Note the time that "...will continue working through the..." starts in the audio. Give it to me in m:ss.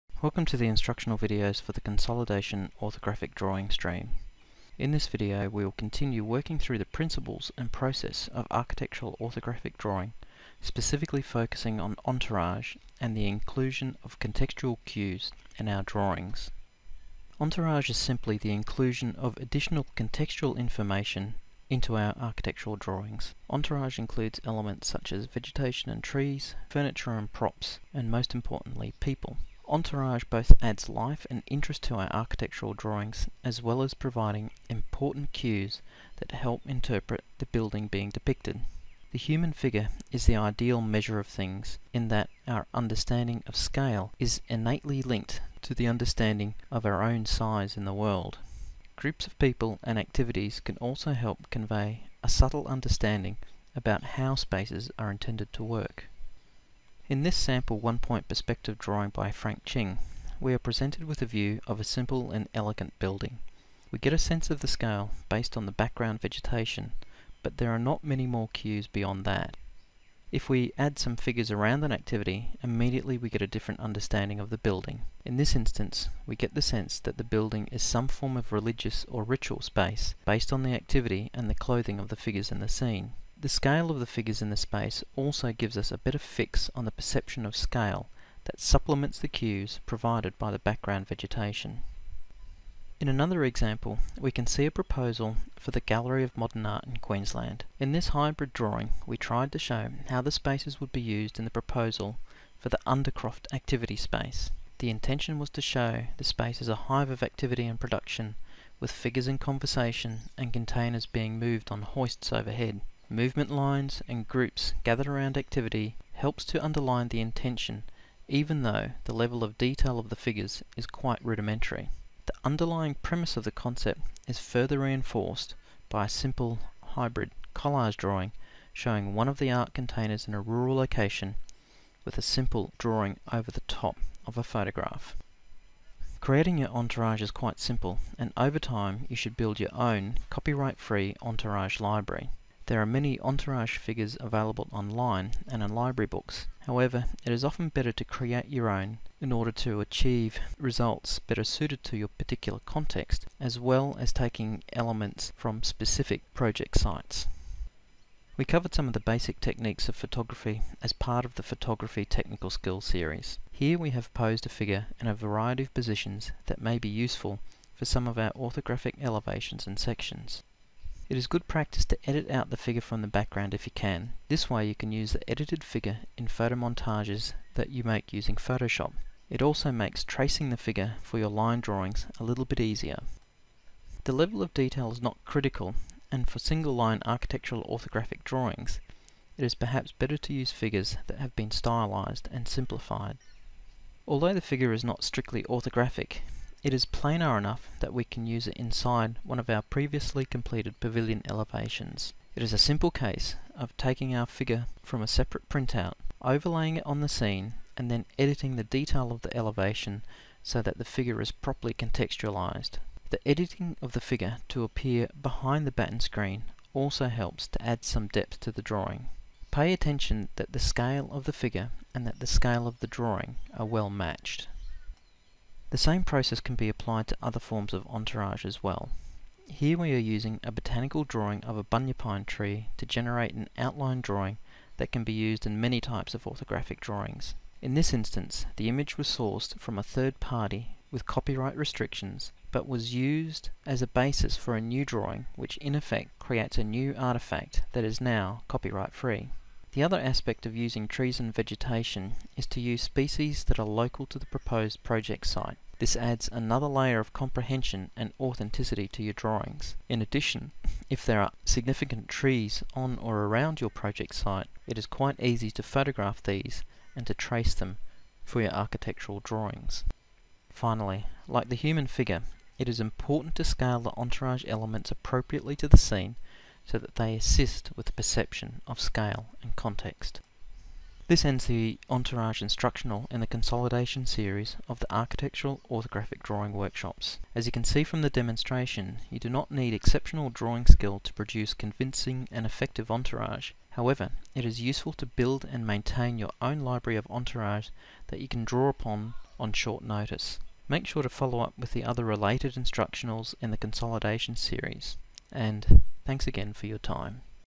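0:05.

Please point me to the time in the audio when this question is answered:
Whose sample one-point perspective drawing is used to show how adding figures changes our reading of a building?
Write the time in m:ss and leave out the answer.
0:59.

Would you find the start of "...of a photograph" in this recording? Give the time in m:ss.
2:14.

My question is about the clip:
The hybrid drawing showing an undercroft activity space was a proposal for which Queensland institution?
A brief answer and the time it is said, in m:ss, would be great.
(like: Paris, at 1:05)
Gallery of Modern Art, at 1:35.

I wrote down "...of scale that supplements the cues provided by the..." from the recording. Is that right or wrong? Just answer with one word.
right.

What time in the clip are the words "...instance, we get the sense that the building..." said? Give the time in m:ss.
1:15.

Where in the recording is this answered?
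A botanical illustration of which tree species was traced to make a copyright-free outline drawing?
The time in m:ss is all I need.
3:51.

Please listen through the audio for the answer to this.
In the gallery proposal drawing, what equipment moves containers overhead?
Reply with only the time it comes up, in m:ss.
1:51.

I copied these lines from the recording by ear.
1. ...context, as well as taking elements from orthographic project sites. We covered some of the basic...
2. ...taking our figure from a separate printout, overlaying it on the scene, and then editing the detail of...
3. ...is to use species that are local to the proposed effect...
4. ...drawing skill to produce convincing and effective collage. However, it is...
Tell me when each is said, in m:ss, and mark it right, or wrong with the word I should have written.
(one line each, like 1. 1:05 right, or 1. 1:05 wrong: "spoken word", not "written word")
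1. 2:32 wrong: "specific", not "orthographic"
2. 3:23 right
3. 4:12 wrong: "project", not "effect"
4. 4:50 wrong: "entourage", not "collage".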